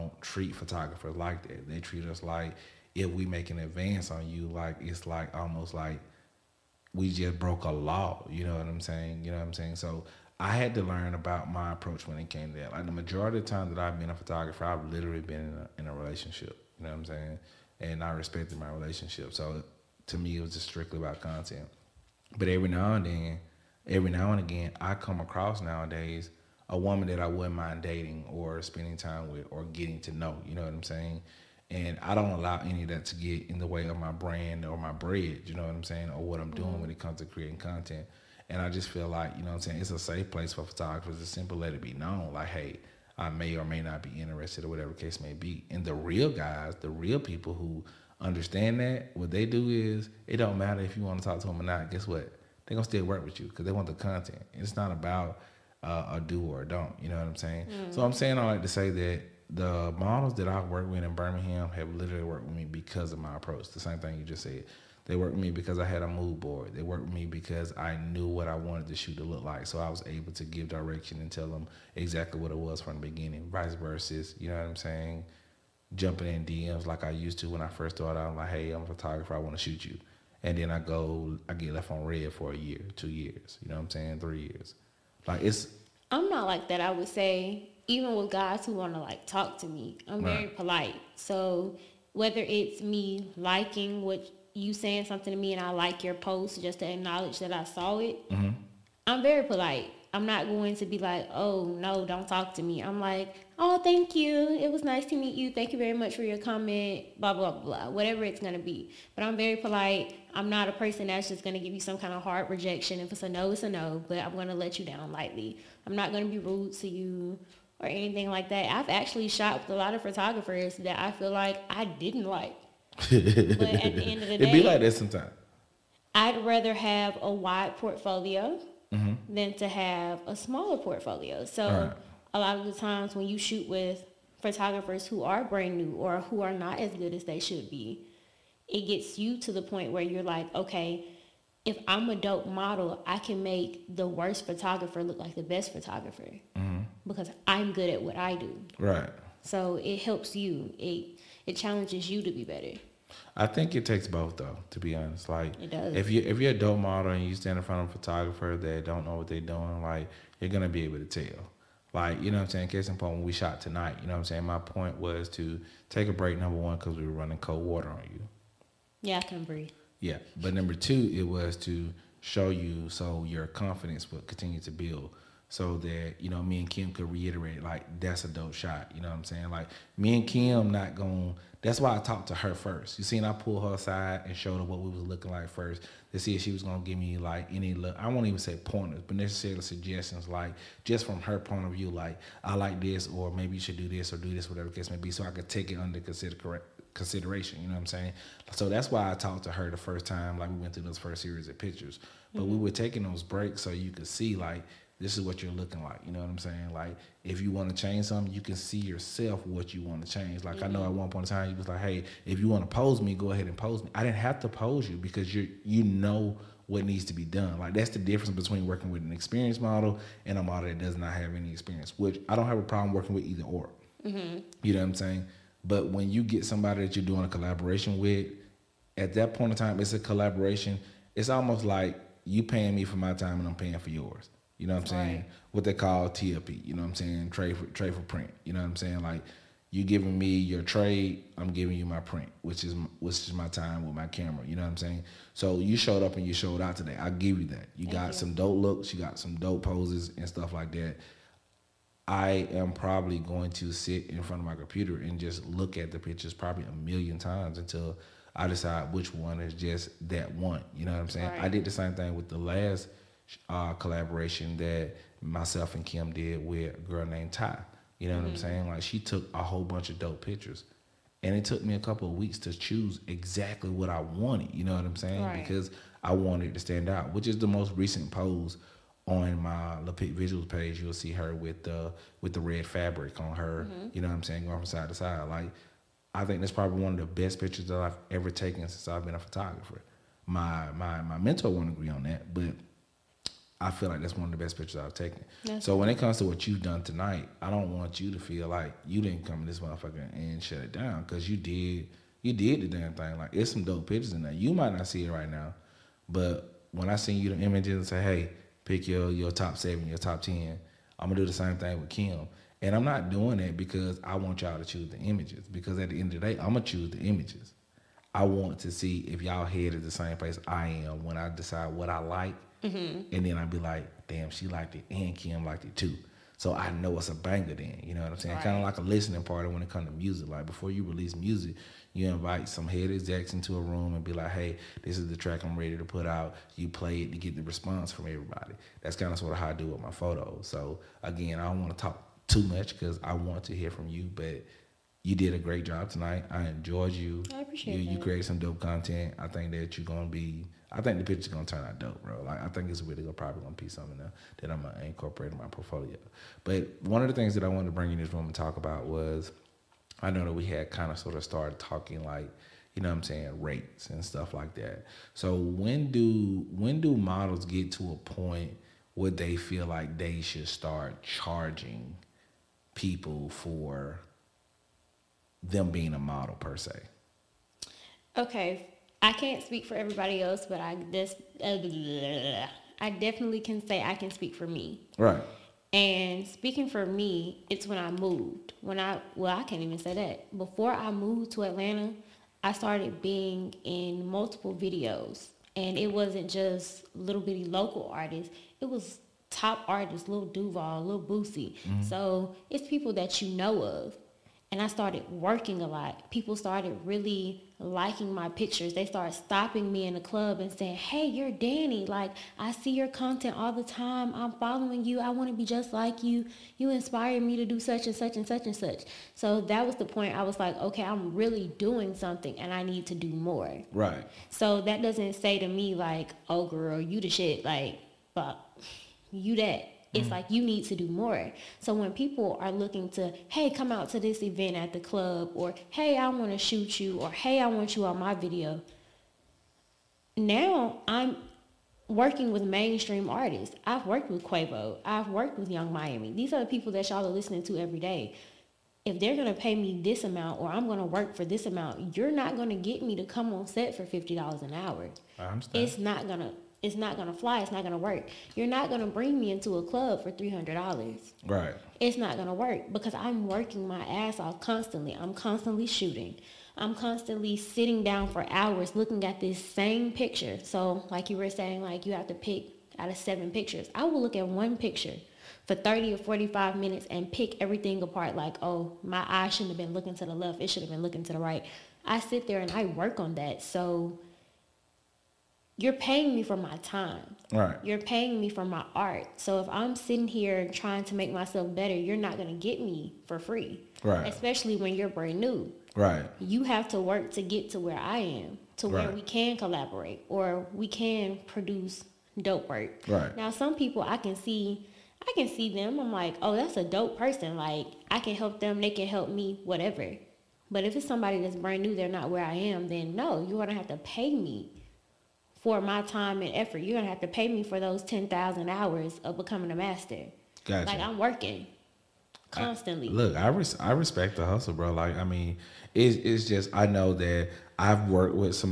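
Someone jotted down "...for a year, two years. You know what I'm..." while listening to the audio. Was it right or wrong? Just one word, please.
right.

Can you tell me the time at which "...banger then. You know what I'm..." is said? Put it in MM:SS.
05:27.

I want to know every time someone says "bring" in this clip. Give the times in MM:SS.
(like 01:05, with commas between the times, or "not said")
05:57, 07:38.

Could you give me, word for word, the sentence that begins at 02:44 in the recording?
My point was to take a break, number one, because we were running cold water on you.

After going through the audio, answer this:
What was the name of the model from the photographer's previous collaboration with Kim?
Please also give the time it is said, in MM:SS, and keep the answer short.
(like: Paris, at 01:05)
Ty, at 04:27.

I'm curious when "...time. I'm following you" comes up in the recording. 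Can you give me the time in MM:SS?
06:53.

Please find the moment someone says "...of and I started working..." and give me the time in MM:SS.
06:43.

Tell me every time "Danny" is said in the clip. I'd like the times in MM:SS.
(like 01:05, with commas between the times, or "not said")
06:51.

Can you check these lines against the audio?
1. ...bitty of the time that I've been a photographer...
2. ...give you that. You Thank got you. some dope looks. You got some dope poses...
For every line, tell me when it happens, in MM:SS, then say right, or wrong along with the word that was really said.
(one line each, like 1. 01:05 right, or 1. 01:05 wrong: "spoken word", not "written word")
1. 00:12 wrong: "majority", not "bitty"
2. 04:07 right.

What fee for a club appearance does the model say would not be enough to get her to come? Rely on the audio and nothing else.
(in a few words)
$300.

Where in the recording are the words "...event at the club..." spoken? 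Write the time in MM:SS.
07:14.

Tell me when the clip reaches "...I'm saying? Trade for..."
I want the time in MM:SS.
03:56.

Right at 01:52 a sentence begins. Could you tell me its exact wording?
If it's a no, it's a no, but I'm going to let you down lightly.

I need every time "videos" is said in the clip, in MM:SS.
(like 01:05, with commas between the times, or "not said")
06:34, 07:18.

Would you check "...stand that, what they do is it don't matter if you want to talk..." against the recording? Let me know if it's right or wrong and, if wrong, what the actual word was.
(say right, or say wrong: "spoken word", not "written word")
wrong: "understand", not "stand".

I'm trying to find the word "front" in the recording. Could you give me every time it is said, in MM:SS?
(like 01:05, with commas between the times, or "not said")
02:37, 04:14.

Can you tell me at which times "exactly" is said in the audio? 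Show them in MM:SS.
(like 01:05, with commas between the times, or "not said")
01:11, 04:33.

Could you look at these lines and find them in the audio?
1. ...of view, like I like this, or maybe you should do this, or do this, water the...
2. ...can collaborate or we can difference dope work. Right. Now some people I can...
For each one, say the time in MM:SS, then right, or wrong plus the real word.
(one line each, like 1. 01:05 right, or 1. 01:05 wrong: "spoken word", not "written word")
1. 03:11 wrong: "whatever", not "water"
2. 08:19 wrong: "produce", not "difference".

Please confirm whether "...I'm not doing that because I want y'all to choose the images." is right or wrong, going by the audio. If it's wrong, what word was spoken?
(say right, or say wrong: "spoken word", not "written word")
right.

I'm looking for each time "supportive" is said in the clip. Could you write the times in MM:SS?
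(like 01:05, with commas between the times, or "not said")
not said.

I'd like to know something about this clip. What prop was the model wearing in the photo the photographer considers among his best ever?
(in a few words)
red fabric.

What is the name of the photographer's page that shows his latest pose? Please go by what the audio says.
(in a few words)
Lapic Visuals.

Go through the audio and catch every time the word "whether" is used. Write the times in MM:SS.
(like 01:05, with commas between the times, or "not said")
01:32.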